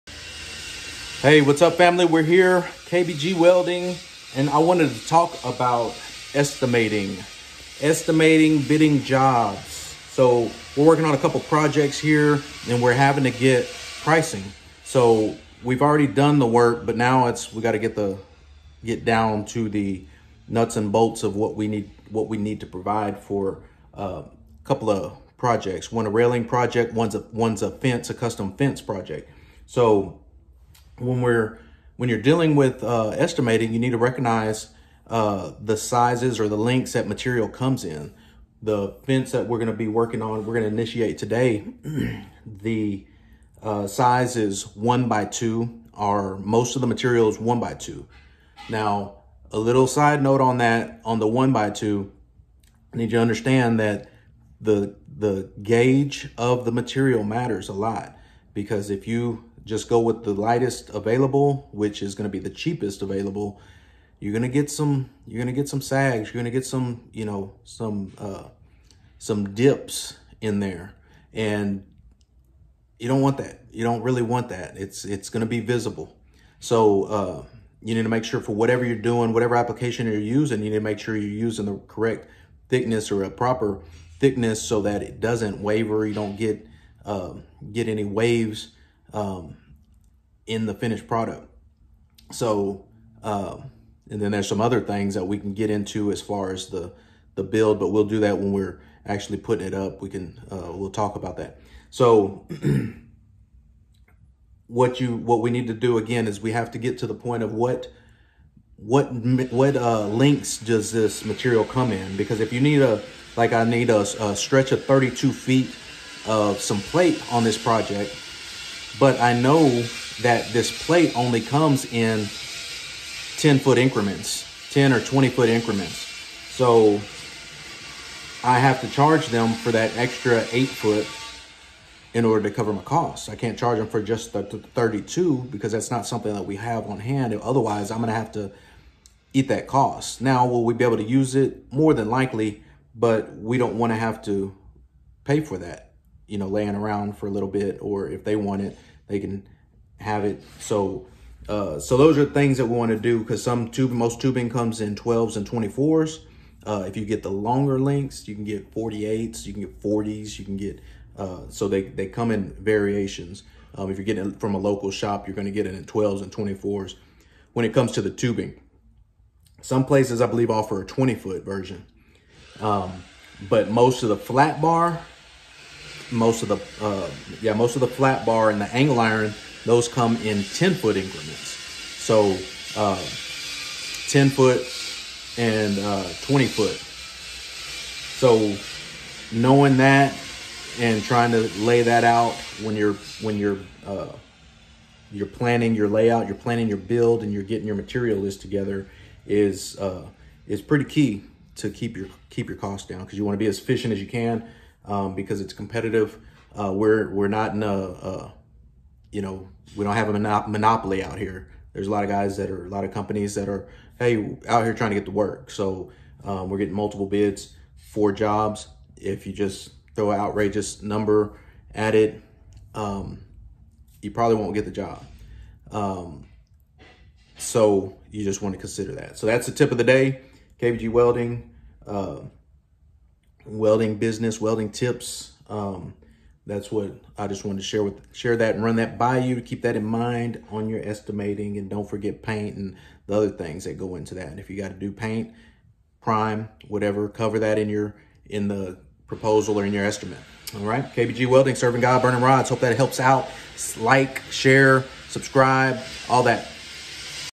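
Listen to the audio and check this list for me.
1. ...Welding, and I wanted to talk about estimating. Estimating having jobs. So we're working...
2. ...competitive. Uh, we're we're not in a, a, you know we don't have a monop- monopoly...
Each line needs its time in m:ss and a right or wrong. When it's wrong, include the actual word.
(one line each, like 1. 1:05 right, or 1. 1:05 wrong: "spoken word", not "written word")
1. 0:03 wrong: "bidding", not "having"
2. 3:25 right.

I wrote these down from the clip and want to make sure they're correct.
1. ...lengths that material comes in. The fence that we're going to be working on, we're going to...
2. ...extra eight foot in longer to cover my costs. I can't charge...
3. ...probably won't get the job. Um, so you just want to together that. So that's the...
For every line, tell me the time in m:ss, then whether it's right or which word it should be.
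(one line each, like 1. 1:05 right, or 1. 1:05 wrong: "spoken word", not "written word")
1. 0:36 right
2. 2:09 wrong: "order", not "longer"
3. 3:44 wrong: "consider", not "together".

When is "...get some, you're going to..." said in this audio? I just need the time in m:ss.
1:04.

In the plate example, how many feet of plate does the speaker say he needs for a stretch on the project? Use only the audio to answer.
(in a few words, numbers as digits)
32 feet.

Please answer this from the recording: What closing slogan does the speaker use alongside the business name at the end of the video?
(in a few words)
Serving God, burning rods.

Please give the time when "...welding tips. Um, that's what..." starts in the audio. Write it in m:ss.
3:54.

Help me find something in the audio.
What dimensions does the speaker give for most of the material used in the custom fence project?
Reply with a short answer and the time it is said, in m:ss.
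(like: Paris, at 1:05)
1 by 2, at 0:44.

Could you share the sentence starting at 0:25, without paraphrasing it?
One a railing project, one's a one's a fence, a custom fence project.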